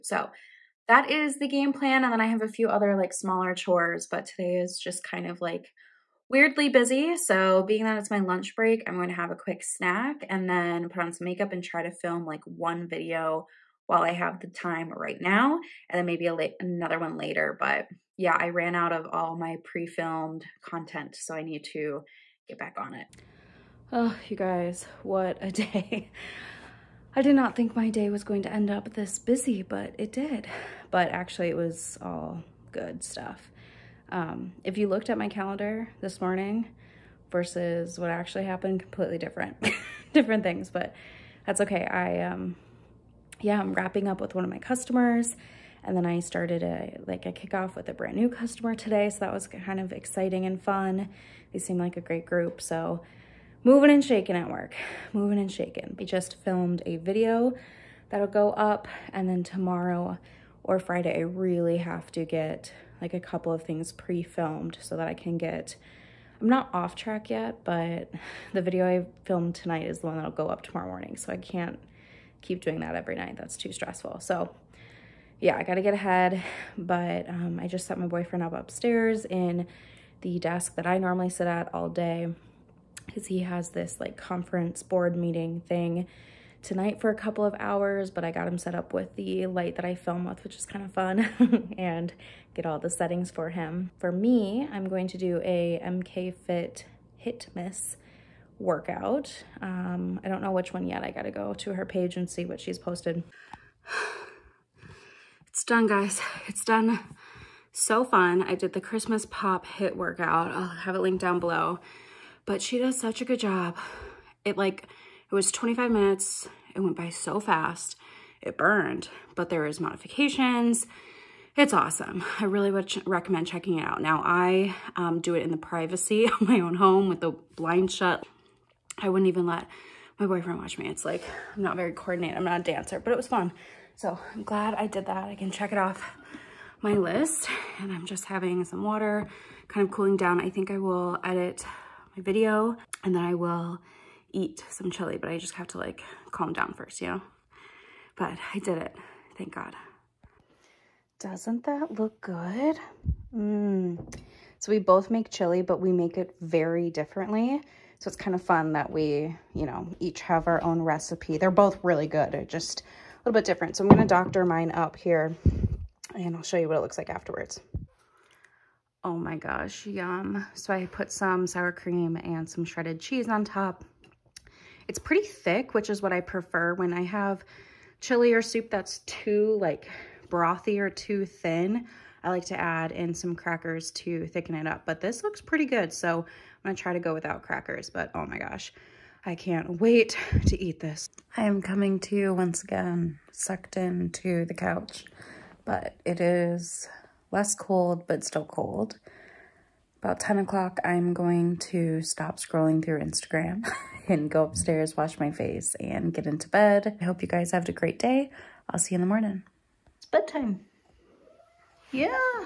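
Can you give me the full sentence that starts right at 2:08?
I wouldn't even let my boyfriend watch me.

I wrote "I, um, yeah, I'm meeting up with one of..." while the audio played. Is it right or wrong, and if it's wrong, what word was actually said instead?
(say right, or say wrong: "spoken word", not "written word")
wrong: "wrapping", not "meeting".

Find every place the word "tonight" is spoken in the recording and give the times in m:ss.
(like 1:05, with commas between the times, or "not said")
1:09, 1:26.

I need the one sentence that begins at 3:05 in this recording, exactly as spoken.
So I'm gonna try to go without crackers, but oh my gosh, I can't wait to eat this.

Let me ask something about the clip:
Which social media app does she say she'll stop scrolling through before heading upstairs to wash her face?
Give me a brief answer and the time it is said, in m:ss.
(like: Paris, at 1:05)
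Instagram, at 3:22.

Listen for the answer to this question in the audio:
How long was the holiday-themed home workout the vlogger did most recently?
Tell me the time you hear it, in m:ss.
1:55.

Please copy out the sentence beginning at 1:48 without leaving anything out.
I did the Christmas pop hit workout.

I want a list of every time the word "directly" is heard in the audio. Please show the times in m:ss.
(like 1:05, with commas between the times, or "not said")
not said.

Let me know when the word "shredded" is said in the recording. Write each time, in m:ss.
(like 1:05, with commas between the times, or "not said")
2:52.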